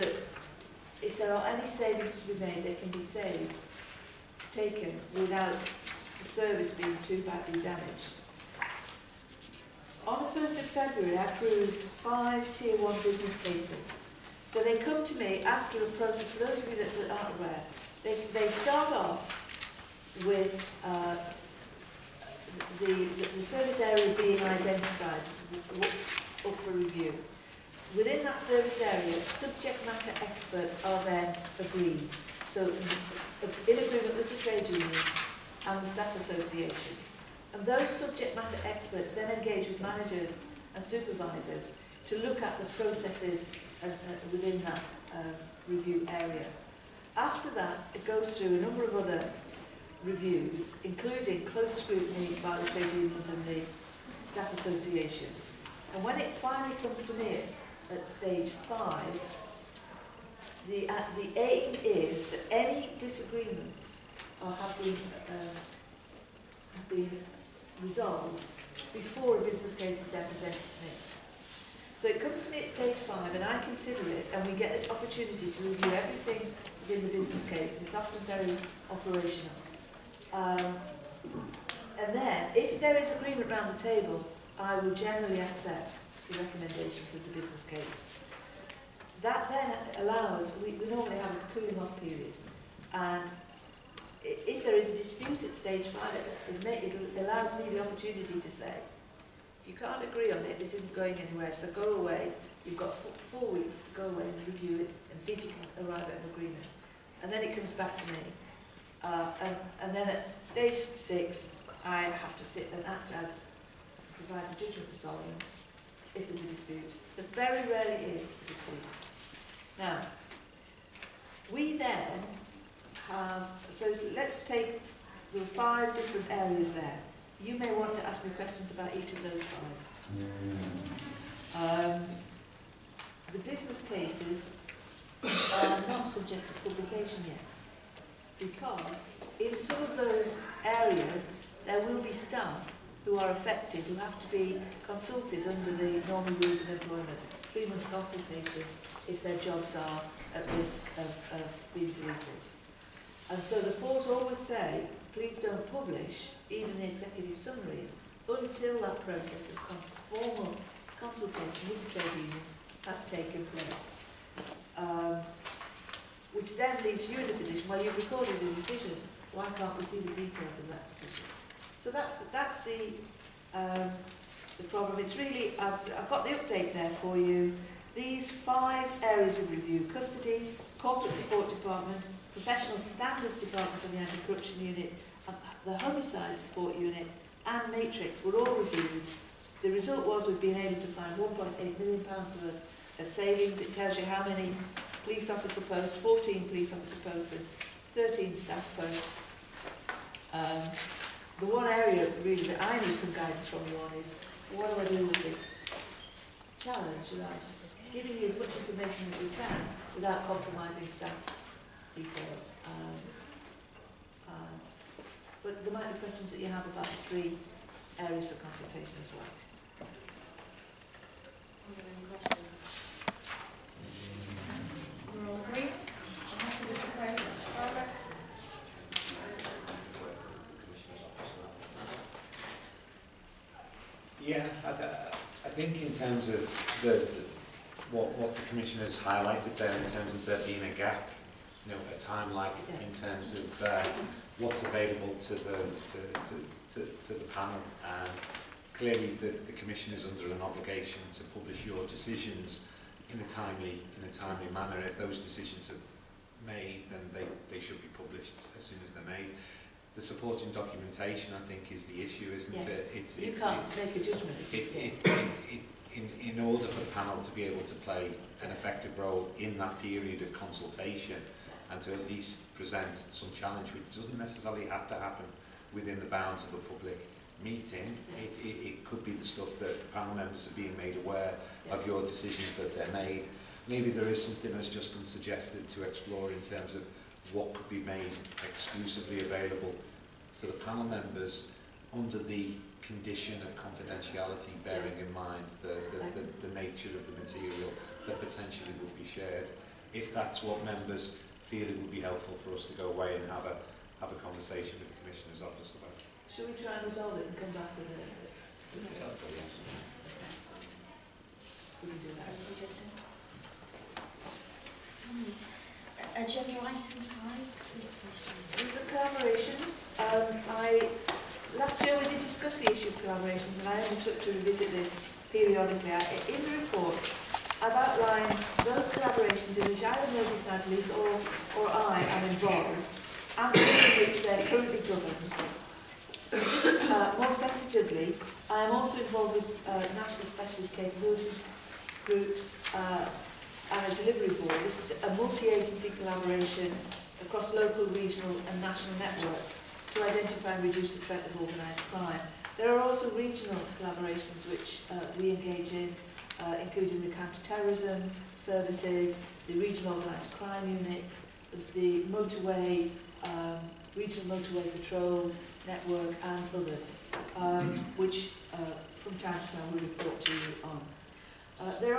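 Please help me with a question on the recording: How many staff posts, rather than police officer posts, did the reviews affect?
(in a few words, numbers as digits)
13.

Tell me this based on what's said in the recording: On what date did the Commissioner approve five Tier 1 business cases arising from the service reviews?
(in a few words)
1 February.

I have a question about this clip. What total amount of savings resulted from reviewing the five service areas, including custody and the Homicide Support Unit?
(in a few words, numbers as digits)
£1.8 million.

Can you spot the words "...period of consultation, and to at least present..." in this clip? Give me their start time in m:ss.
4:29.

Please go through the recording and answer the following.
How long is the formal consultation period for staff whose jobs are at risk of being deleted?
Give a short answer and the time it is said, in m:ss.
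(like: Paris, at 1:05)
3 months, at 2:27.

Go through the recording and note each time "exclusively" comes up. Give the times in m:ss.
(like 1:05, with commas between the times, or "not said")
4:48.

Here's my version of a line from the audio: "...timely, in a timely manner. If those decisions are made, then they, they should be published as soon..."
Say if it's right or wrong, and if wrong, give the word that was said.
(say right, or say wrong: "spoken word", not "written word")
right.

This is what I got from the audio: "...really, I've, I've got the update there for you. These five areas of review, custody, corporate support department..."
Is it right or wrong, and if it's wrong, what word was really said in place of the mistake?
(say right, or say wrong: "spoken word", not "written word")
right.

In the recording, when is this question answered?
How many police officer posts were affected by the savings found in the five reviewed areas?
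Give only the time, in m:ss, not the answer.
3:15.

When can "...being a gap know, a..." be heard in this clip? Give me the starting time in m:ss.
4:00.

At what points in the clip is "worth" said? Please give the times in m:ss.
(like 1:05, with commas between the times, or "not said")
3:12.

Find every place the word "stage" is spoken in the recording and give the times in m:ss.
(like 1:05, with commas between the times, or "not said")
0:58, 1:12, 1:35, 1:50.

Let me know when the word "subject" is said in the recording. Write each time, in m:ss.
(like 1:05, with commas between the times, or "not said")
0:29, 0:37, 2:16.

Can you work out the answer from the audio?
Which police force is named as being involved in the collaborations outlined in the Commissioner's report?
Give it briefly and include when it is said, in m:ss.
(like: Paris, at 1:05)
Merseyside Police, at 5:30.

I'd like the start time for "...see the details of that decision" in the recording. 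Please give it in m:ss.
2:49.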